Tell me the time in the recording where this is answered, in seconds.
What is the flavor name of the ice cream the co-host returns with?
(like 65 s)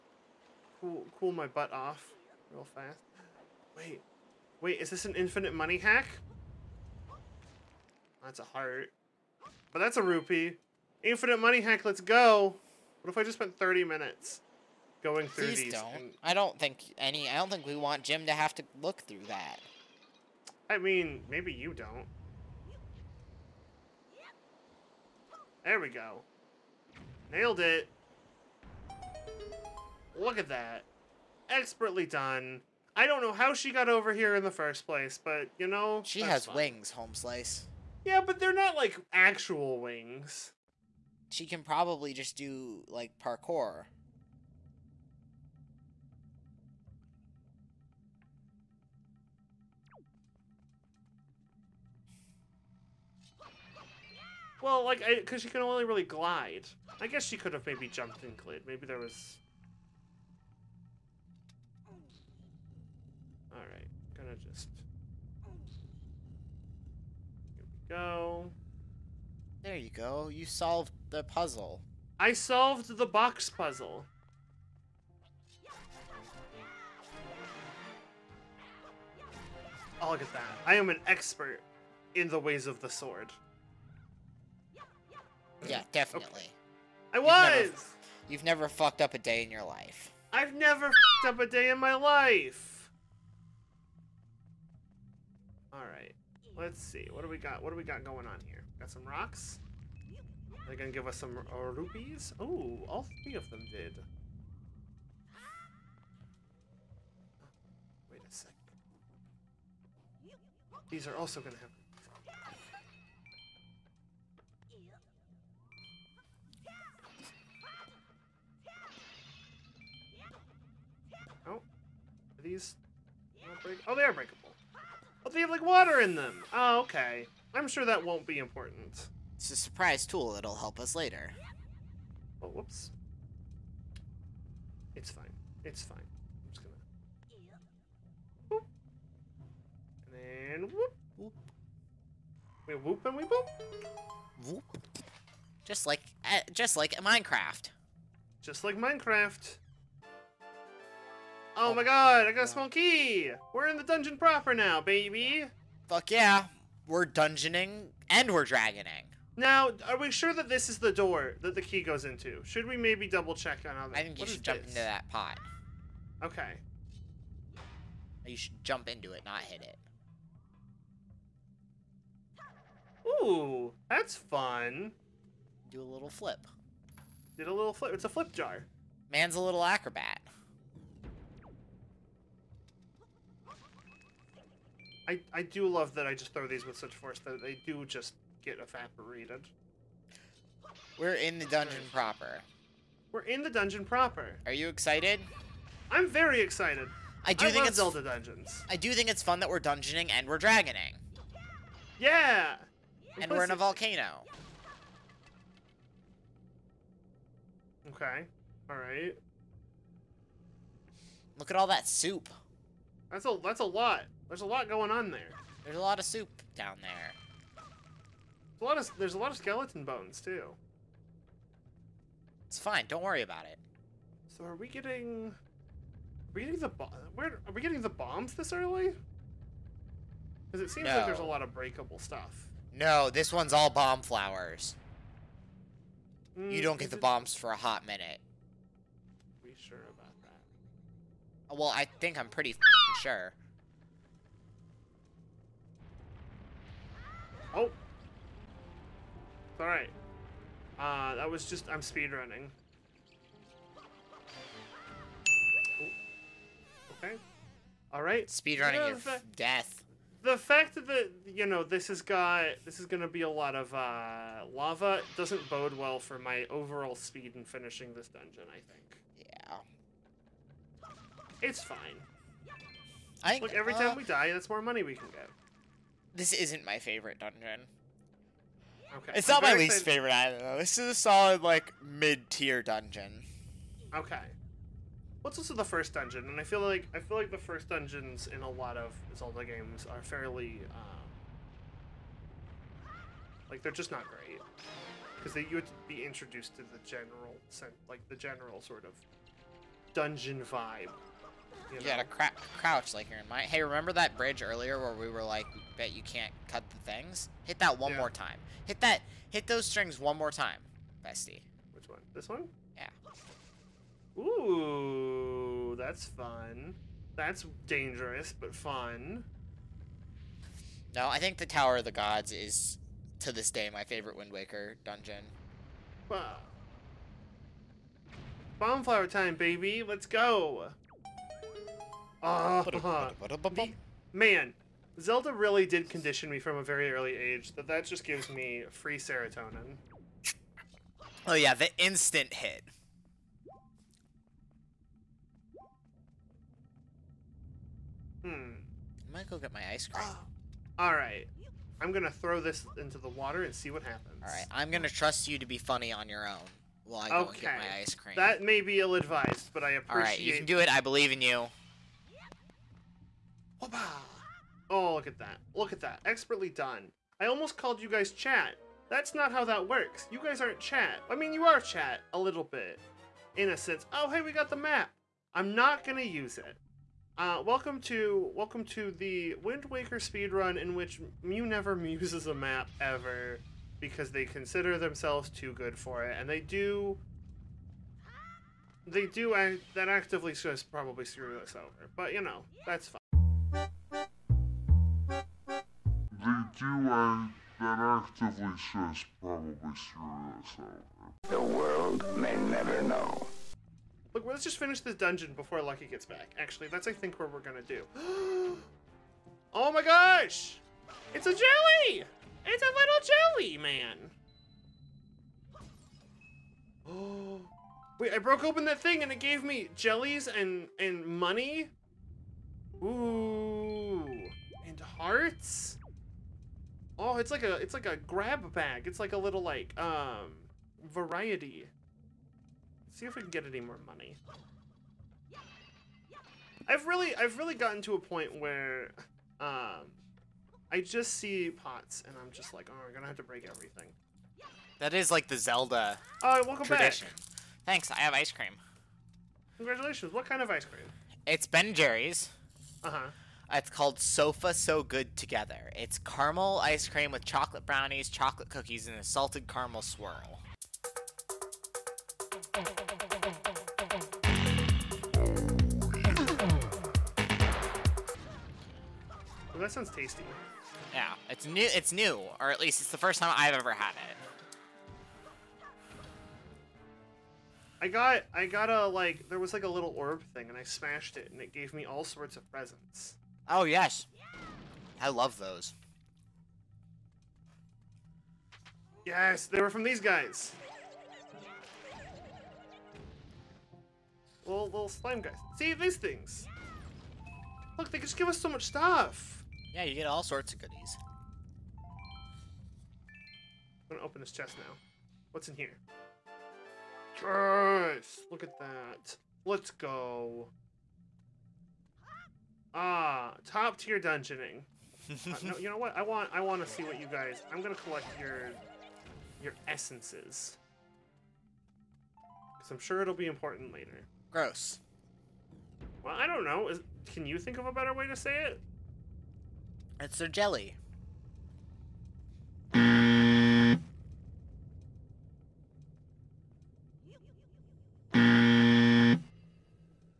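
453 s.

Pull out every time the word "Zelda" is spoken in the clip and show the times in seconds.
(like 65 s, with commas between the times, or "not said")
197 s, 289 s, 334 s, 445 s.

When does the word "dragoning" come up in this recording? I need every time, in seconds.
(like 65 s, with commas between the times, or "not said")
158 s, 200 s.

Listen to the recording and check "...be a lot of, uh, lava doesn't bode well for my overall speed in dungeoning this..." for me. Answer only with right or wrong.
wrong.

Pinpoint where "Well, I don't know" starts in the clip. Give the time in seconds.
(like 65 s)
526 s.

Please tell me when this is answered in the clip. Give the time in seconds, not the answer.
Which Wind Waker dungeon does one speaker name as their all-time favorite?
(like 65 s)
321 s.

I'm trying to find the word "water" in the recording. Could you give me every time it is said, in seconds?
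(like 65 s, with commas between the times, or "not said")
125 s, 353 s.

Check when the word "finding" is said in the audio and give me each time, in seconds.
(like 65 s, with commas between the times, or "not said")
not said.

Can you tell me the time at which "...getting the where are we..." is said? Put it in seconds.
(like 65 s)
226 s.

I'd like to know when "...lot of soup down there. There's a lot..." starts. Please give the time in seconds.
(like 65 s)
215 s.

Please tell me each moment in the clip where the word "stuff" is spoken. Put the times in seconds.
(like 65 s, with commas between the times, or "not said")
231 s, 498 s.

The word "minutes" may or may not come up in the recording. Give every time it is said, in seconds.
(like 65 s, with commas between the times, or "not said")
13 s, 237 s.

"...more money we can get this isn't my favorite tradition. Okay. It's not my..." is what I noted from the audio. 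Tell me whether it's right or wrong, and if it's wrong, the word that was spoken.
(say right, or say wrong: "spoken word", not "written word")
wrong: "dungeon", not "tradition".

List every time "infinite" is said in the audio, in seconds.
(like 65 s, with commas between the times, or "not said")
5 s, 11 s.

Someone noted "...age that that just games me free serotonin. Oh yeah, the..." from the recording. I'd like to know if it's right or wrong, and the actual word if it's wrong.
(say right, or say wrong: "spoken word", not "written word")
wrong: "gives", not "games".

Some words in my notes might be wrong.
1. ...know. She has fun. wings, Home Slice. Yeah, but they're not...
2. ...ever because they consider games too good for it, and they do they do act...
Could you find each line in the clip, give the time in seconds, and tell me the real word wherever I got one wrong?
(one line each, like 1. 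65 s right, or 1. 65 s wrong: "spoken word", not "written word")
1. 35 s right
2. 382 s wrong: "themselves", not "games".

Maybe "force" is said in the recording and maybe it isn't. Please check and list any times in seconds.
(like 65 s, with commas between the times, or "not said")
186 s.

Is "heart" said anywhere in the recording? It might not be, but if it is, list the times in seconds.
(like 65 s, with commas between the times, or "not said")
8 s, 424 s.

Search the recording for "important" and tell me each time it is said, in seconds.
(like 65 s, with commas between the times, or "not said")
128 s, 523 s.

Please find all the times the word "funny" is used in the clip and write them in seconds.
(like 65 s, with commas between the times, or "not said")
355 s.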